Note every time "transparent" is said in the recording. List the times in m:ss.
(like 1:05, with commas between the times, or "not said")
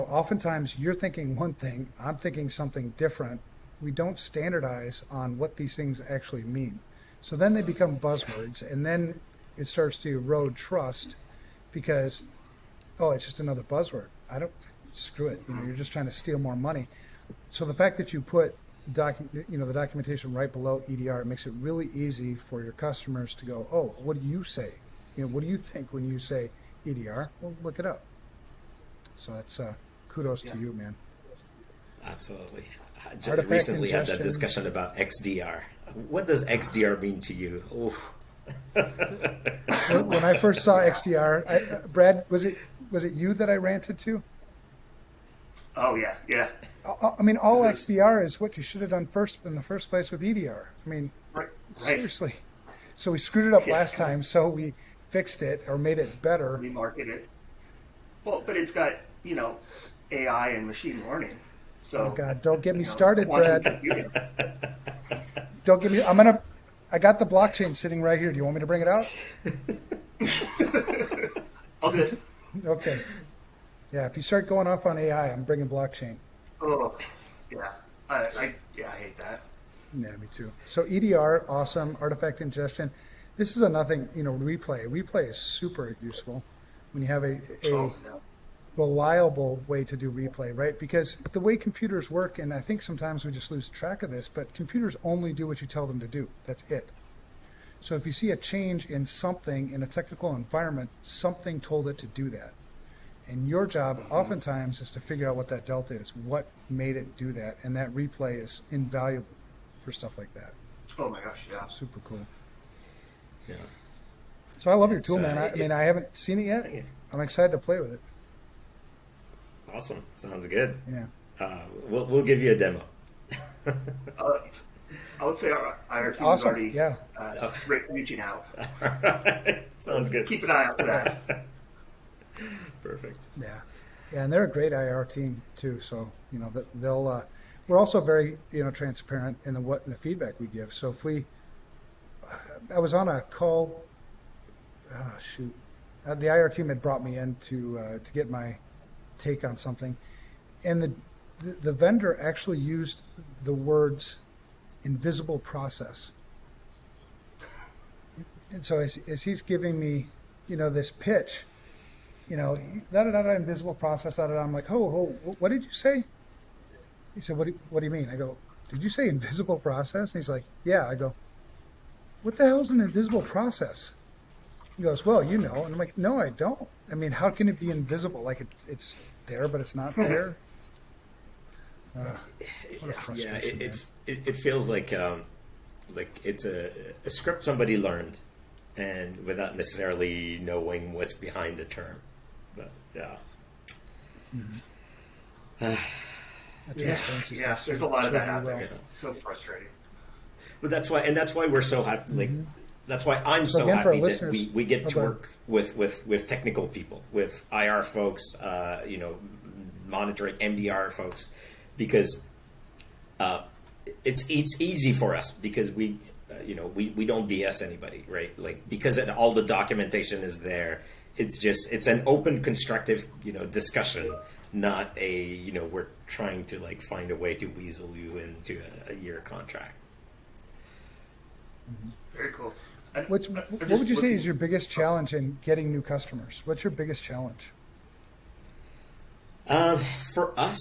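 2:18.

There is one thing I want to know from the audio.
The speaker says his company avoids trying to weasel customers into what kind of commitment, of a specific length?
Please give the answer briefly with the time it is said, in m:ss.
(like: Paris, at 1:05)
A year contract, at 3:48.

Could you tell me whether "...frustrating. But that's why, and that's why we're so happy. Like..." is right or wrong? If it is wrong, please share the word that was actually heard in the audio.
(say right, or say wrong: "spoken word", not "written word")
right.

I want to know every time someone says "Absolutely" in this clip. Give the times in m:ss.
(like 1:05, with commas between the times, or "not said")
0:32.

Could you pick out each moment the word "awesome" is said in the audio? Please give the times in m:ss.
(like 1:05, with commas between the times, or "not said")
1:21, 1:59, 2:06.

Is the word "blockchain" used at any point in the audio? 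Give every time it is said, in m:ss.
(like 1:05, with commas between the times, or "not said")
1:07, 1:15.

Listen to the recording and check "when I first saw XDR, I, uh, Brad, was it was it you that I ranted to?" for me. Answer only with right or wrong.
right.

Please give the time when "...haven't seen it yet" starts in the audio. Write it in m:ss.
1:55.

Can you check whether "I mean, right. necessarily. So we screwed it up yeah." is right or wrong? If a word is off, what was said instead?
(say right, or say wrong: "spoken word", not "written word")
wrong: "seriously", not "necessarily".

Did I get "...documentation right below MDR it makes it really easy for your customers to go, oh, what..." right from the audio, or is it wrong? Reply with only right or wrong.
wrong.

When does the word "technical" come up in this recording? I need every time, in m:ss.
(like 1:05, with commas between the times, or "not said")
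1:39, 3:26.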